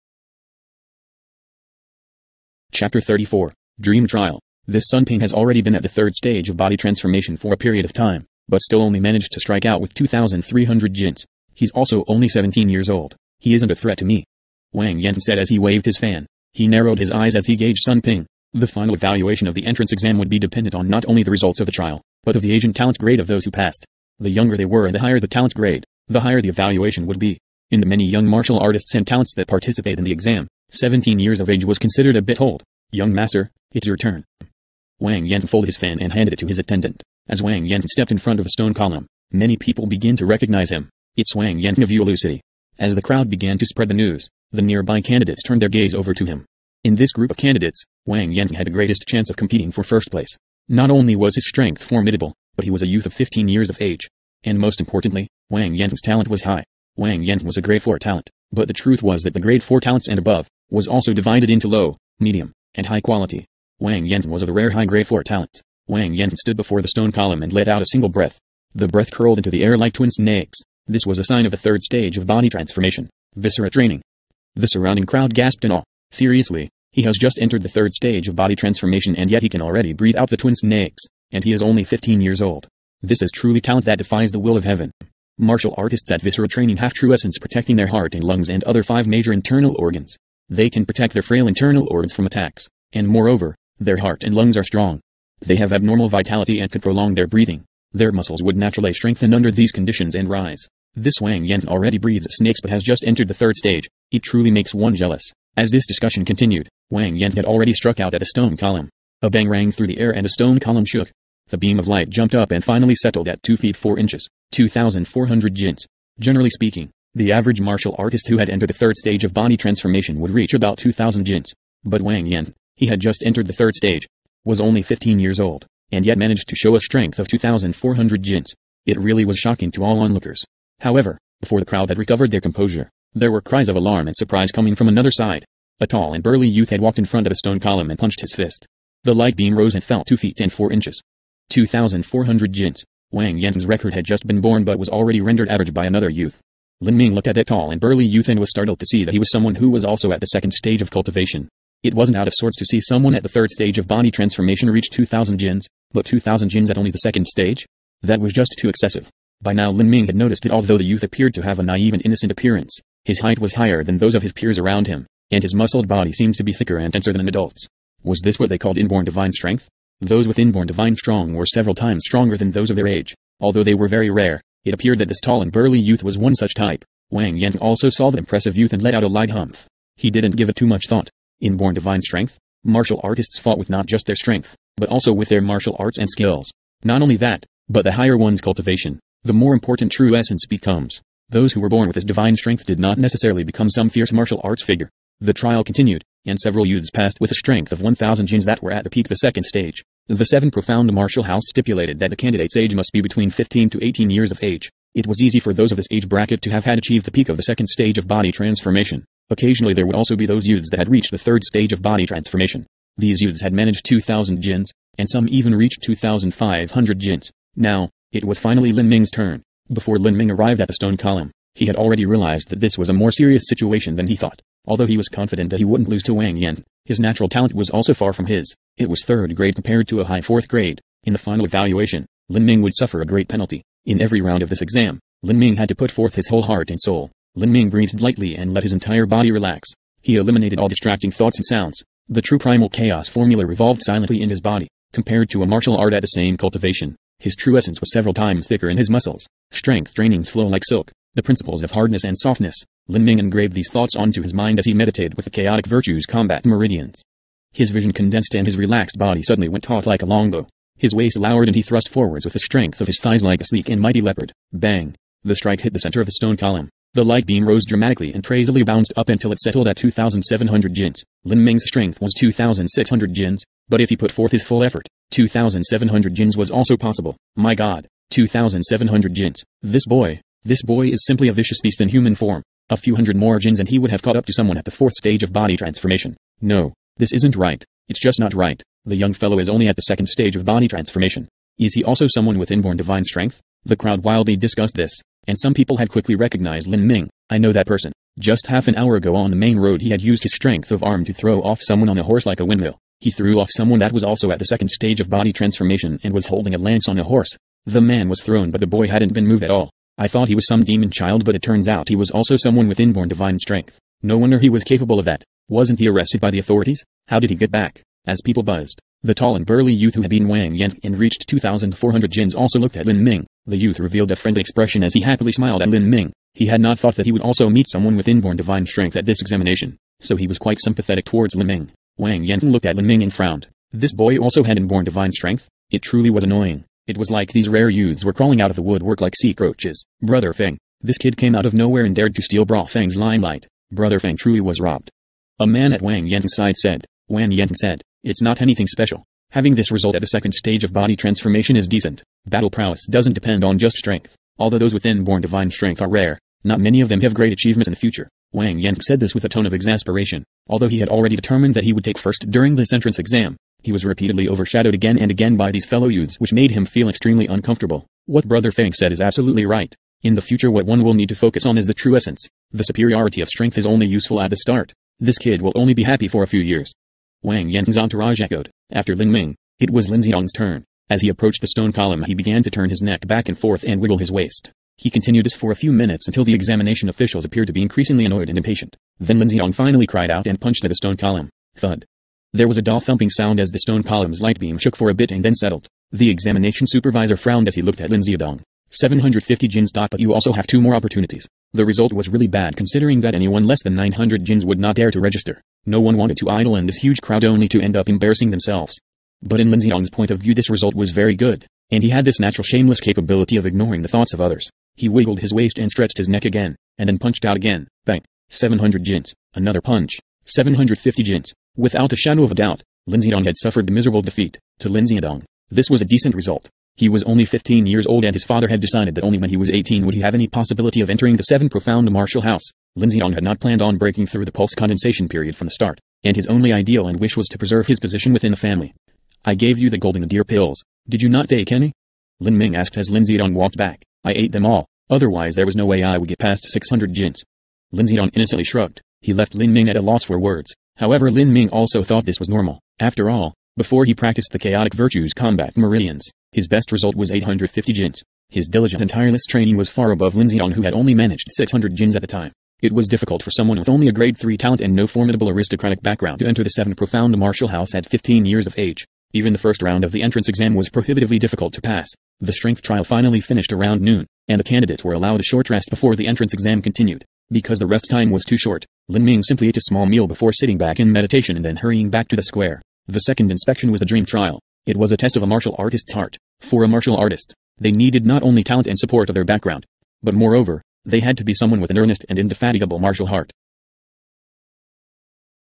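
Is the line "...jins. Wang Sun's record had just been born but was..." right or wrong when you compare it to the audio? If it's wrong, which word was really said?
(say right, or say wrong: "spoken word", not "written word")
wrong: "Yan", not "Sun".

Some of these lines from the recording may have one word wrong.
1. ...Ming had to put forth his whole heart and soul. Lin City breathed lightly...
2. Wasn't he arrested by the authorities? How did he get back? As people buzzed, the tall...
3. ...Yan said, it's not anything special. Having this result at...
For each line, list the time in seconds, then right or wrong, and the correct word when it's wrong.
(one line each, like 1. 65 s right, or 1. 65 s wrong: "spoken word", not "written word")
1. 235 s wrong: "Ming", not "City"
2. 315 s right
3. 347 s right.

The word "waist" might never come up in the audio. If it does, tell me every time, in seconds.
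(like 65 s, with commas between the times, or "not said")
260 s, 384 s, 415 s.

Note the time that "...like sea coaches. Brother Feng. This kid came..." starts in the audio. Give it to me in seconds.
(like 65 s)
339 s.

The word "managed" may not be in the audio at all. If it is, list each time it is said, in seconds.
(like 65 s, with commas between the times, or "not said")
8 s, 126 s, 213 s, 460 s.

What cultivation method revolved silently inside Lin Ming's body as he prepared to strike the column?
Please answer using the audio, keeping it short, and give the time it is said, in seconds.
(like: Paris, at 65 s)
true primal chaos formula, at 242 s.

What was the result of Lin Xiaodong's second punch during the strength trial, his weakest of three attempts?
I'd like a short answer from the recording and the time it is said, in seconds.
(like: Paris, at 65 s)
700 jins, at 418 s.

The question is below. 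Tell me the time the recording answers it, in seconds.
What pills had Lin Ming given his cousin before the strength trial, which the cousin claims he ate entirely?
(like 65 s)
439 s.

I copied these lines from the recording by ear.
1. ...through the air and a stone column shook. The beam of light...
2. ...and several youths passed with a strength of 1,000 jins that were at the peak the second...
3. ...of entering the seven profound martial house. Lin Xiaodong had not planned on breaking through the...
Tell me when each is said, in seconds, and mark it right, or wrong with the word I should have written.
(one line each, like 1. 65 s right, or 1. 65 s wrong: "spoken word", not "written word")
1. 109 s right
2. 196 s right
3. 430 s right.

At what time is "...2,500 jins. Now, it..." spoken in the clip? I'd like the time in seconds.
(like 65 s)
215 s.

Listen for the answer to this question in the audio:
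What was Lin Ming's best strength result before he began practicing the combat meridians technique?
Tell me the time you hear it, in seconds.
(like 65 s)
457 s.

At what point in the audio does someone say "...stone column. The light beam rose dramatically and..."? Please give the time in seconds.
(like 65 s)
266 s.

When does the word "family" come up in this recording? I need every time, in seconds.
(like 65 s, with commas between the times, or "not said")
438 s.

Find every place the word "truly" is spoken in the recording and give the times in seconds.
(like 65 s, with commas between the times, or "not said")
83 s, 104 s, 335 s, 344 s.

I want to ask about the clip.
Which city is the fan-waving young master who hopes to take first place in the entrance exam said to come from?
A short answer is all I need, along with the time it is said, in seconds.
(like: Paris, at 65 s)
Yulu City, at 41 s.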